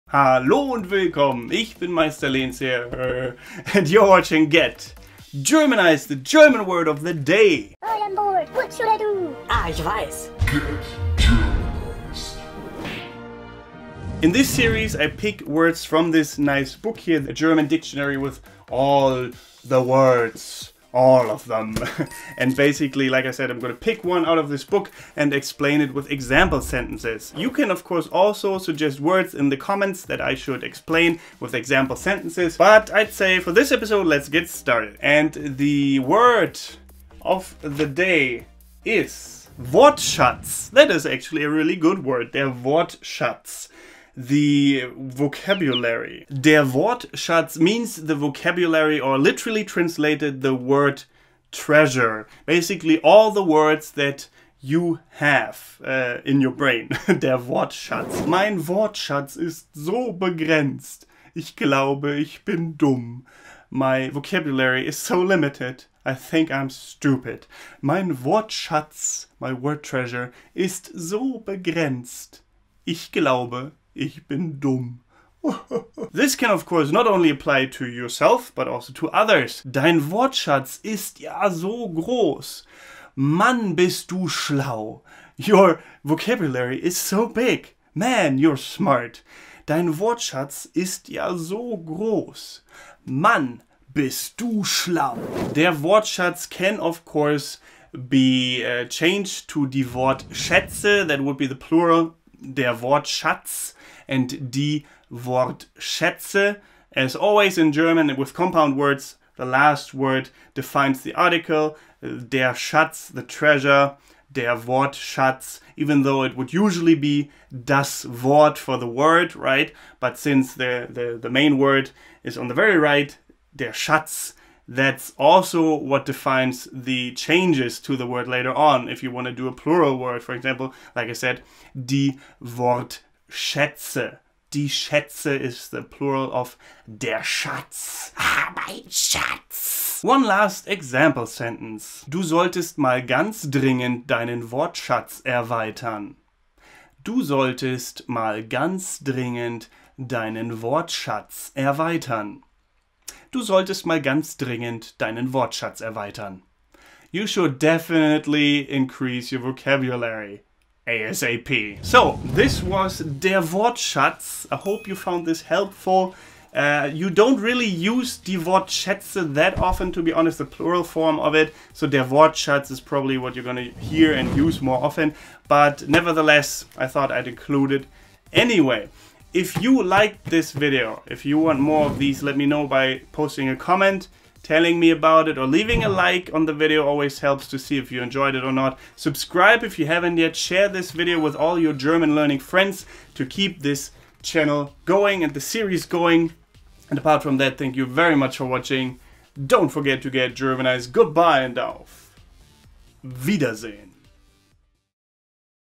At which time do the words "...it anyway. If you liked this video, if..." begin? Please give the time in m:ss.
2:57.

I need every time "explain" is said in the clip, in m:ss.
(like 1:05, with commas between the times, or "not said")
0:25, 0:30.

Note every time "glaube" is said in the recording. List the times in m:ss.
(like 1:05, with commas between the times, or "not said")
1:01, 1:13.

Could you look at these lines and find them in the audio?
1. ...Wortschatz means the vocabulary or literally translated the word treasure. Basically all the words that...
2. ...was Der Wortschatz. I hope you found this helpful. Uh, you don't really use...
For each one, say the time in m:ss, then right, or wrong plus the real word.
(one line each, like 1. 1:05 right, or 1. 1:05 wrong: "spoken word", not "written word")
1. 0:46 right
2. 2:42 right.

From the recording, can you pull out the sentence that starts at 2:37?
You should definitely increase your vocabulary.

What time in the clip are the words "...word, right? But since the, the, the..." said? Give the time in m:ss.
1:58.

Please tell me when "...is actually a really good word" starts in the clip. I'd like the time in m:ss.
0:40.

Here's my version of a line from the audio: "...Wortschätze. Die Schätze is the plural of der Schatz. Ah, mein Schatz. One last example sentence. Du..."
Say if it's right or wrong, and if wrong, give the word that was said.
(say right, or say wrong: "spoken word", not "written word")
right.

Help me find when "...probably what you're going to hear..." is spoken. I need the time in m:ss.
2:52.